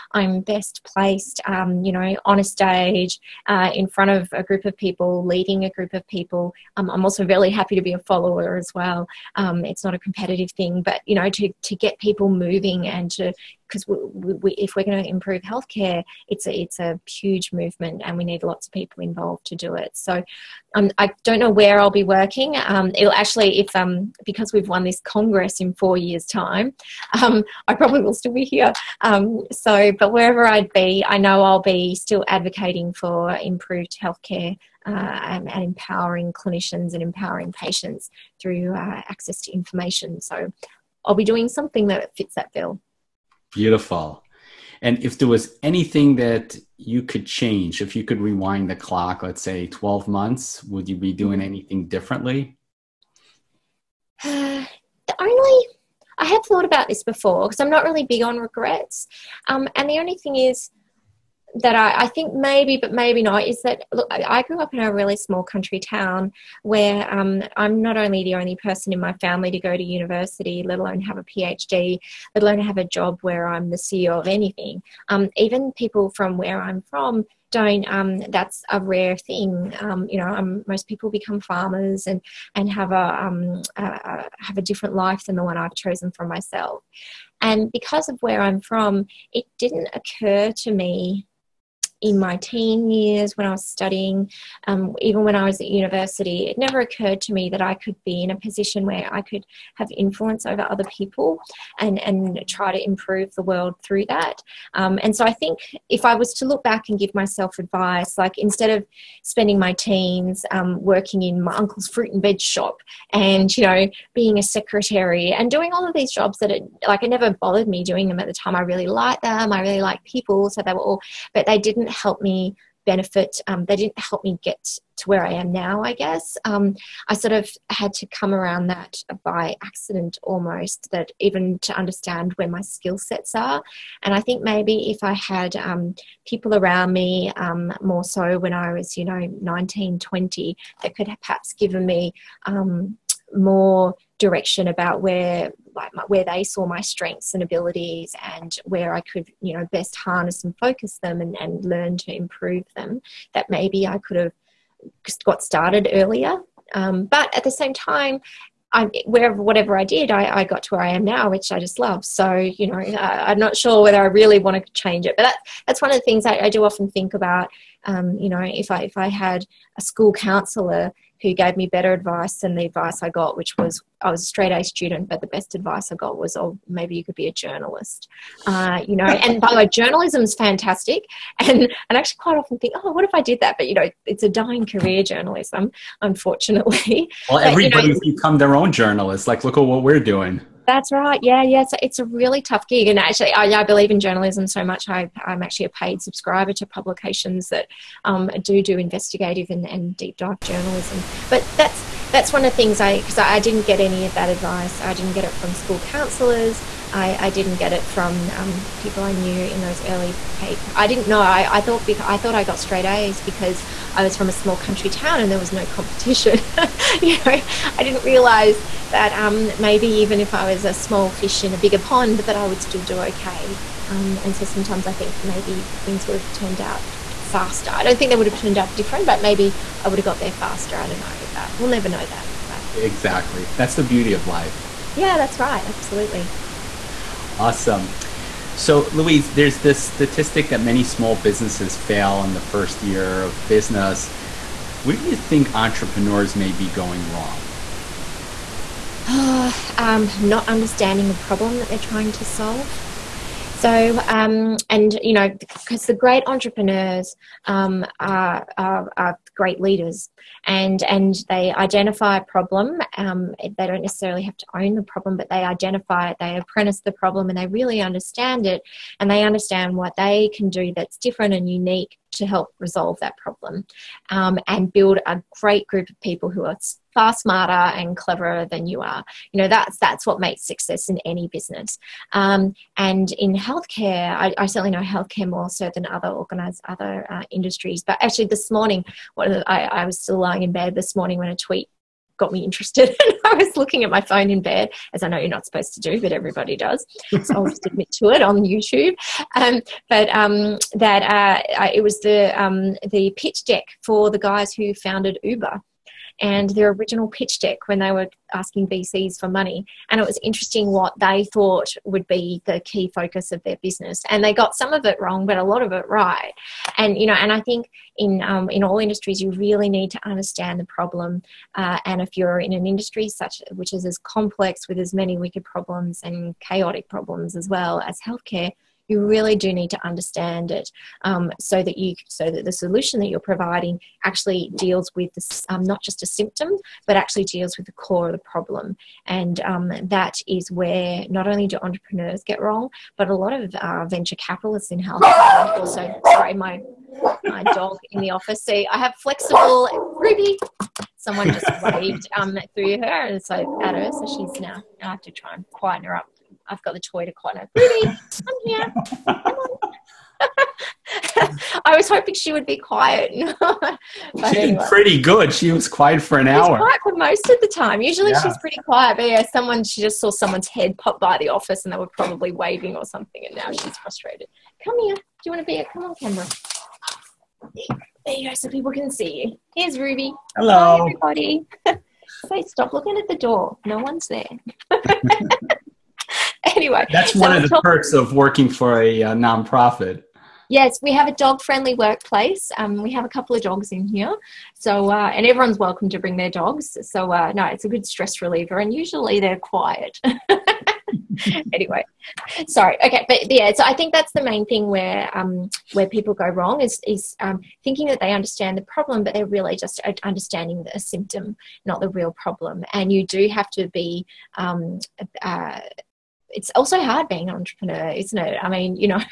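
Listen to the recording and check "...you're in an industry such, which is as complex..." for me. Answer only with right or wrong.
right.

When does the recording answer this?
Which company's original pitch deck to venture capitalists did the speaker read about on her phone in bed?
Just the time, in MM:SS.
05:05.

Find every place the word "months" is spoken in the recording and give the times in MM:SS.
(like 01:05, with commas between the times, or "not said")
00:50.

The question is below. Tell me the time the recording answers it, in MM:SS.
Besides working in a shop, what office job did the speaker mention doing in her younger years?
01:54.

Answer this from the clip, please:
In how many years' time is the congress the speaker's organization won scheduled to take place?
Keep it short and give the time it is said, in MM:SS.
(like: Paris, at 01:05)
4, at 00:25.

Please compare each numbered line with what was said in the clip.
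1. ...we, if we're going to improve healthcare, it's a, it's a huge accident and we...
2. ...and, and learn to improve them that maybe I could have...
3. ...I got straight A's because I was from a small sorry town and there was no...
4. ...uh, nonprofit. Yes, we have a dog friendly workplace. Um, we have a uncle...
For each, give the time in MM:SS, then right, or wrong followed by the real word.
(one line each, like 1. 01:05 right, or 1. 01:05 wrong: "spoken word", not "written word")
1. 00:14 wrong: "movement", not "accident"
2. 02:31 right
3. 03:32 wrong: "country", not "sorry"
4. 06:29 wrong: "couple", not "uncle".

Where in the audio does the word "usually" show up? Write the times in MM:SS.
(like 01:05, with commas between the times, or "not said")
06:07, 06:38.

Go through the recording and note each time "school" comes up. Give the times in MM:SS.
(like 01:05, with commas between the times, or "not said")
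02:49, 03:25.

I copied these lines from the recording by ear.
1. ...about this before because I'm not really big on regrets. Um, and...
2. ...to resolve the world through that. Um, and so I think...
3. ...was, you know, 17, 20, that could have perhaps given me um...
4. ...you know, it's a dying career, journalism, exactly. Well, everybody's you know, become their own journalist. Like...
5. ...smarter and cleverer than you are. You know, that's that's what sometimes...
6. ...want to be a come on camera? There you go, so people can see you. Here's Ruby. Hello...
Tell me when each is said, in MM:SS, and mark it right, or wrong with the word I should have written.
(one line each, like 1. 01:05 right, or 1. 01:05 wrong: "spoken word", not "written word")
1. 00:56 right
2. 01:42 wrong: "improve", not "resolve"
3. 02:18 wrong: "19", not "17"
4. 03:03 wrong: "unfortunately", not "exactly"
5. 04:37 wrong: "makes", not "sometimes"
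6. 06:15 right.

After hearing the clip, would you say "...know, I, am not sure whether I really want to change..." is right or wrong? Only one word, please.
right.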